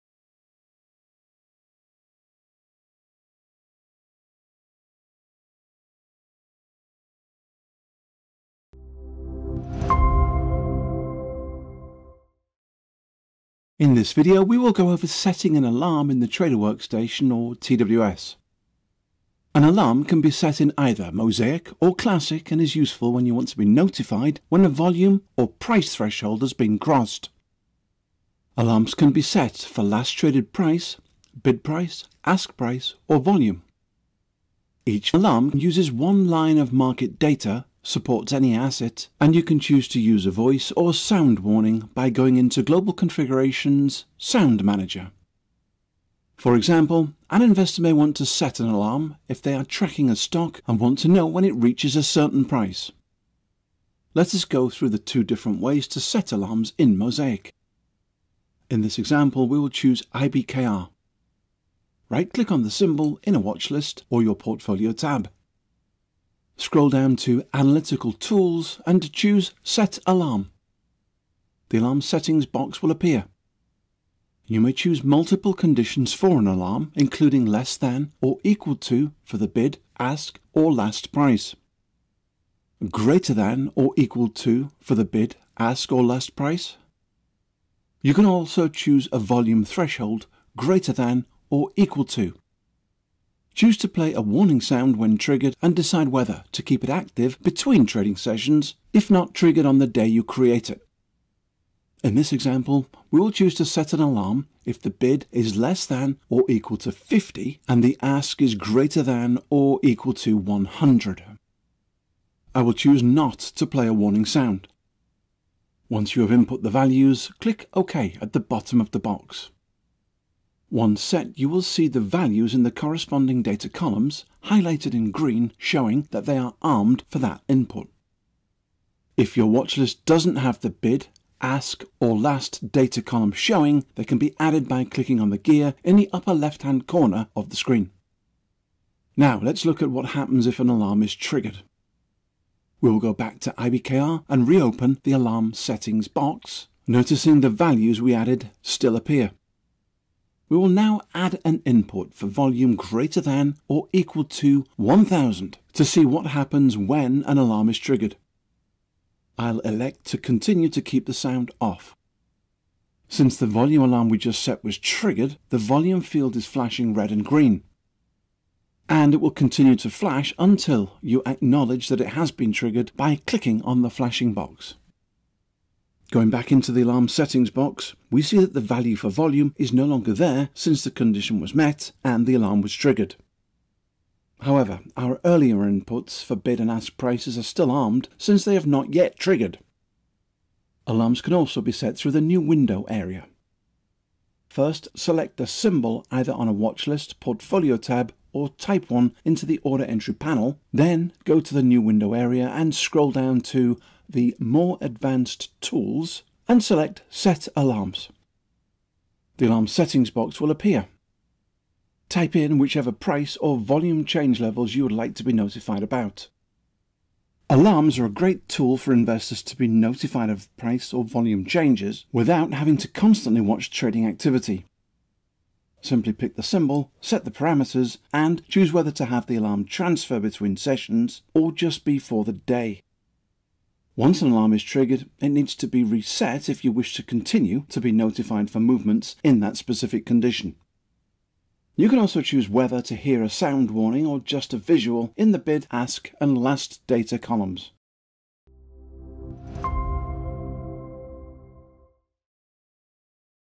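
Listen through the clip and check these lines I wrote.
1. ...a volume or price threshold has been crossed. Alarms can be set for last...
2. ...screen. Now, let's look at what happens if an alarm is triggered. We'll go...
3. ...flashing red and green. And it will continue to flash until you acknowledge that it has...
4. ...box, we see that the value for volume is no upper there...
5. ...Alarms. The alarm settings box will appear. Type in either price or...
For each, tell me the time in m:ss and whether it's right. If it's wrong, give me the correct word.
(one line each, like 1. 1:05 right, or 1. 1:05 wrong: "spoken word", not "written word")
1. 0:24 right
2. 2:17 right
3. 2:46 right
4. 2:57 wrong: "longer", not "upper"
5. 3:27 wrong: "whichever", not "either".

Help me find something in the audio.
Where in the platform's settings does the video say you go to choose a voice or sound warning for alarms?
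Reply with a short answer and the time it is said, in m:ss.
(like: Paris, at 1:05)
Sound Manager, at 0:44.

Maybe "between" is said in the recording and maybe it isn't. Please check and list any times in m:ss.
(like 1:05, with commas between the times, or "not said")
1:37, 3:50.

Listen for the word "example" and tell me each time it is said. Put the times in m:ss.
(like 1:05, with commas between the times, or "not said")
0:46, 0:58, 1:42.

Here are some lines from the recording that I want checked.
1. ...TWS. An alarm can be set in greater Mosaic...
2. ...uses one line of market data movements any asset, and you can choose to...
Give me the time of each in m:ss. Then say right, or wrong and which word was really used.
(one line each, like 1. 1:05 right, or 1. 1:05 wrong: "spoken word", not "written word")
1. 0:17 wrong: "either", not "greater"
2. 0:35 wrong: "supports", not "movements".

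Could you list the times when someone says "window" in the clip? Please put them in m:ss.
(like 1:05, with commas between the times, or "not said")
3:12, 3:21.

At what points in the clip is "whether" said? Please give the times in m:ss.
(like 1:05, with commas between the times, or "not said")
1:36, 3:48, 4:02.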